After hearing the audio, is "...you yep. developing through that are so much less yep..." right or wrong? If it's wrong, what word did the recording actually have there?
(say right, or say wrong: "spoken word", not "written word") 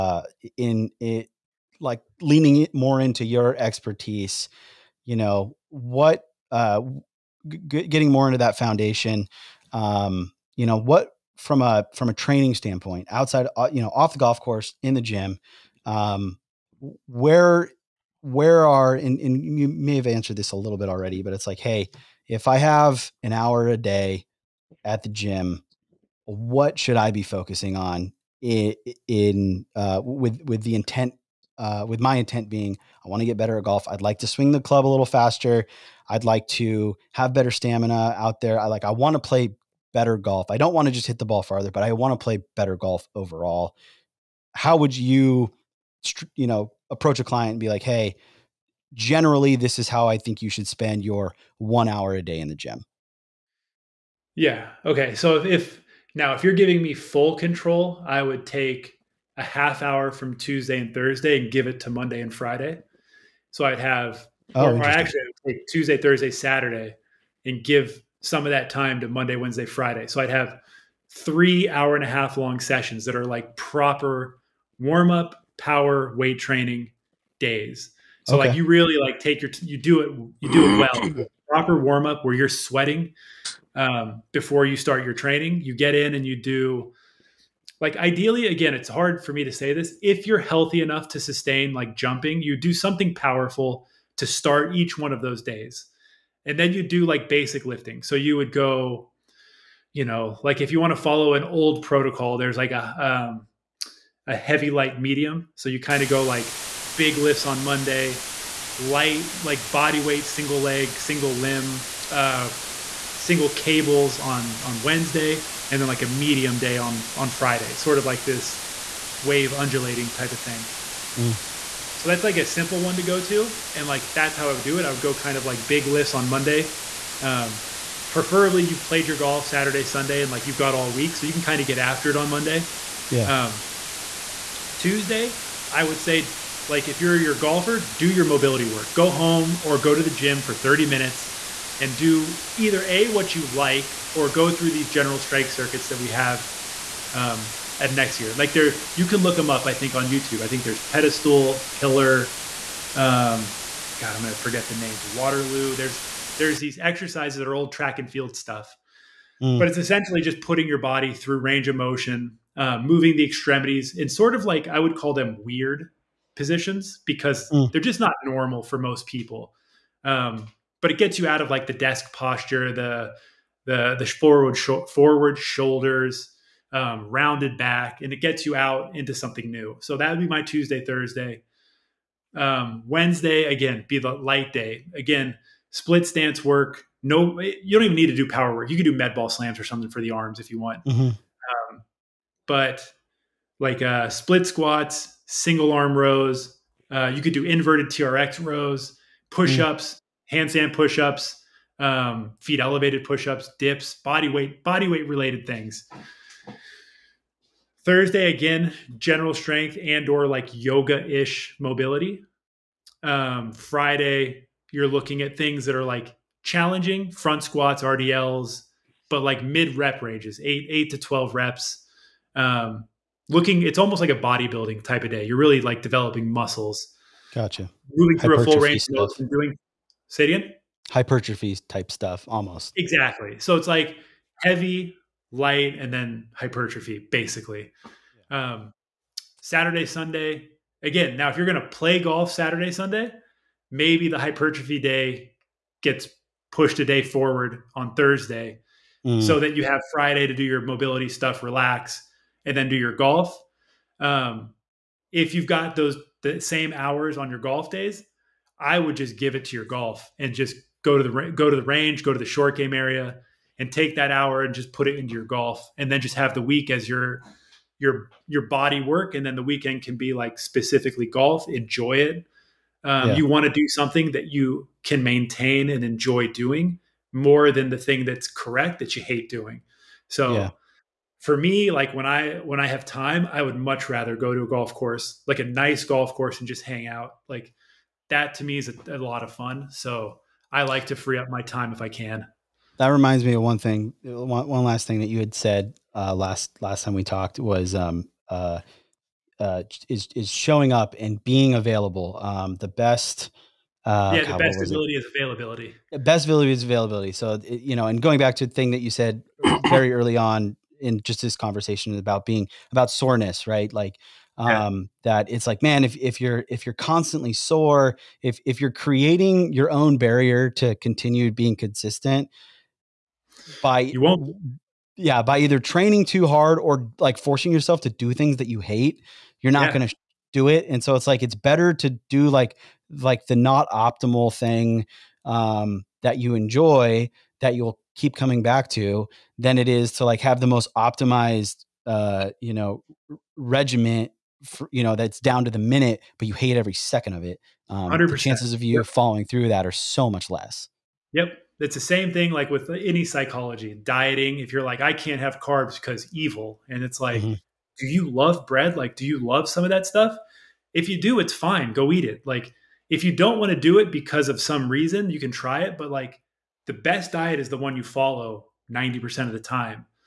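wrong: "following", not "developing".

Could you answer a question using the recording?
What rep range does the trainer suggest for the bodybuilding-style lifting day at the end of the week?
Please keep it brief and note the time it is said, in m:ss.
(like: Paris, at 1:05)
8 to 12, at 3:40.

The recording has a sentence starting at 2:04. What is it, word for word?
I would go kind of like big lifts on Monday.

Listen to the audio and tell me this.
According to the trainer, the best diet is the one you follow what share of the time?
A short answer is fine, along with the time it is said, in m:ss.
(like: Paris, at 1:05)
90%, at 6:08.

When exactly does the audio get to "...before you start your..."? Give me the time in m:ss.
1:24.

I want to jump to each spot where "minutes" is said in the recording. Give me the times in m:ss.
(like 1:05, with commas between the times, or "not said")
2:20, 5:45.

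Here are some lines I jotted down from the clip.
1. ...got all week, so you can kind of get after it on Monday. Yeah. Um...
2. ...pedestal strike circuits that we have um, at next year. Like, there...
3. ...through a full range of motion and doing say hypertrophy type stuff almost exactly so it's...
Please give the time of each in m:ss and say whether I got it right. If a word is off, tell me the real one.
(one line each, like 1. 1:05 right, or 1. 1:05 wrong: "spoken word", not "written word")
1. 2:10 right
2. 2:24 wrong: "general", not "pedestal"
3. 3:48 right.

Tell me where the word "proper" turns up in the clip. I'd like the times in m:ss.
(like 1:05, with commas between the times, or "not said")
1:13, 1:21.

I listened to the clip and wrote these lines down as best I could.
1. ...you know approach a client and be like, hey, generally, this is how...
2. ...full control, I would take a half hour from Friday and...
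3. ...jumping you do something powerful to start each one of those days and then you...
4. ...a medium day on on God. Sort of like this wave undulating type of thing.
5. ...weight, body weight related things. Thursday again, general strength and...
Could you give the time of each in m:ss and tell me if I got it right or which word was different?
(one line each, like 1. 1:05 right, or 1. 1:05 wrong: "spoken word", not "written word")
1. 0:46 right
2. 0:56 wrong: "Tuesday", not "Friday"
3. 1:31 right
4. 1:56 wrong: "Friday", not "God"
5. 3:24 right.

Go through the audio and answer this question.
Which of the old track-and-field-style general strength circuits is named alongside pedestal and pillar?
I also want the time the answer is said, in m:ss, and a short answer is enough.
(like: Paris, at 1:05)
Waterloo, at 2:35.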